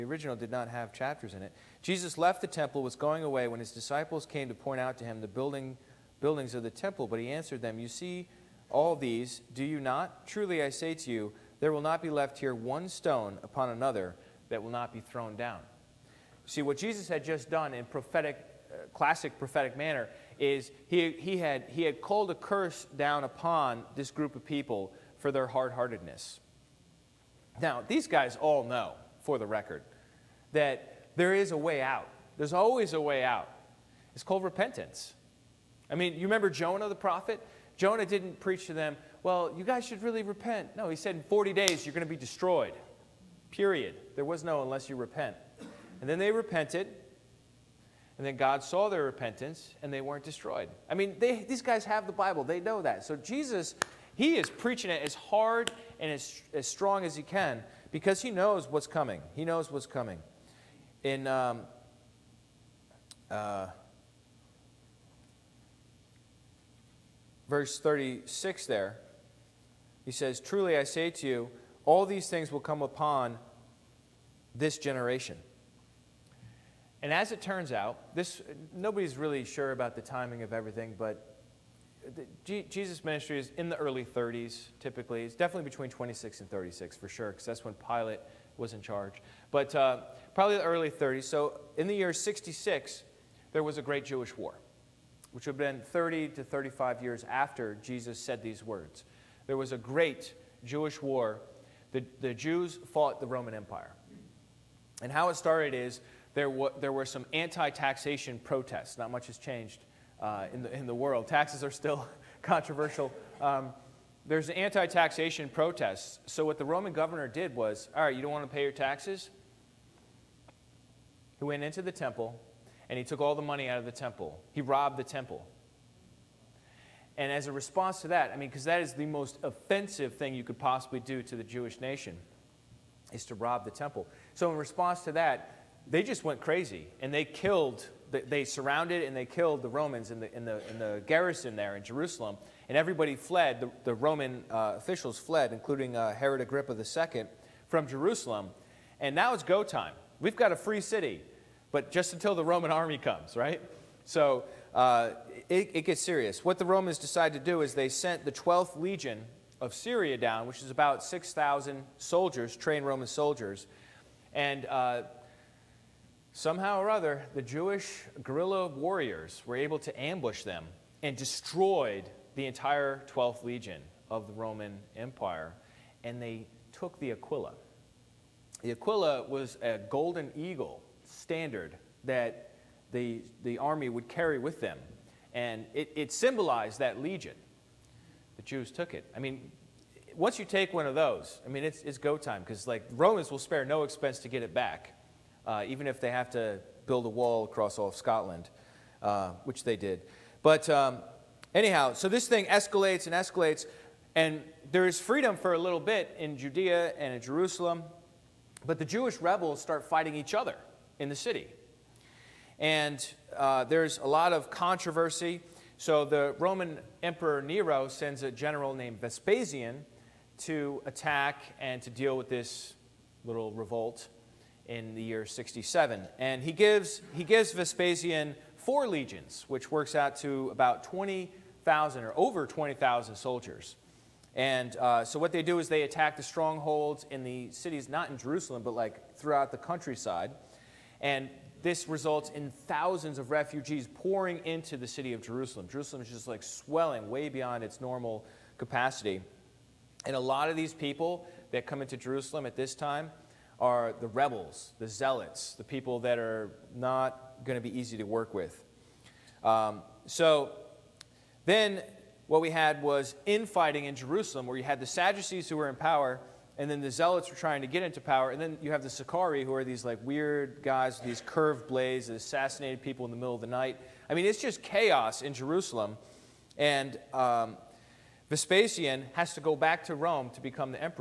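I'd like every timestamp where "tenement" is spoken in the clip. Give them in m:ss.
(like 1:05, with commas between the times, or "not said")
not said.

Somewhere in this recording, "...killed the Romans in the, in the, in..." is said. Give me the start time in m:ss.
2:19.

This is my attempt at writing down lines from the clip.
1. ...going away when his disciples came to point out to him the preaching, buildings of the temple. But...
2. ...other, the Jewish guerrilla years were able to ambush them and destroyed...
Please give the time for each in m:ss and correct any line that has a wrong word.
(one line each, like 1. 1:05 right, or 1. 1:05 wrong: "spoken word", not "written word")
1. 0:02 wrong: "building", not "preaching"
2. 2:46 wrong: "warriors", not "years".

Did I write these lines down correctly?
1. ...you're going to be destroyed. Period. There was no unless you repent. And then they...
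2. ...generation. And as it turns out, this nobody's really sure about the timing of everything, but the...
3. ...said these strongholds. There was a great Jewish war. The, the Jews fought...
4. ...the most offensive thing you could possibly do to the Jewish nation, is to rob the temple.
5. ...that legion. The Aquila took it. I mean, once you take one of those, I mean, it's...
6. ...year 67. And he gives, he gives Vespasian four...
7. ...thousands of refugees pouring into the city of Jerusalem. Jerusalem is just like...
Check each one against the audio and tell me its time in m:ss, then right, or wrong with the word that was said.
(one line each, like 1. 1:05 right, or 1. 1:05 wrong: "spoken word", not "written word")
1. 0:41 right
2. 1:14 right
3. 1:38 wrong: "words", not "strongholds"
4. 2:08 right
5. 3:06 wrong: "Jews", not "Aquila"
6. 3:45 right
7. 4:02 right.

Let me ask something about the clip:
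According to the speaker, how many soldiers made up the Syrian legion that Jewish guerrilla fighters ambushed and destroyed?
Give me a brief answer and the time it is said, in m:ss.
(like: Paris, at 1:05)
6,000, at 2:41.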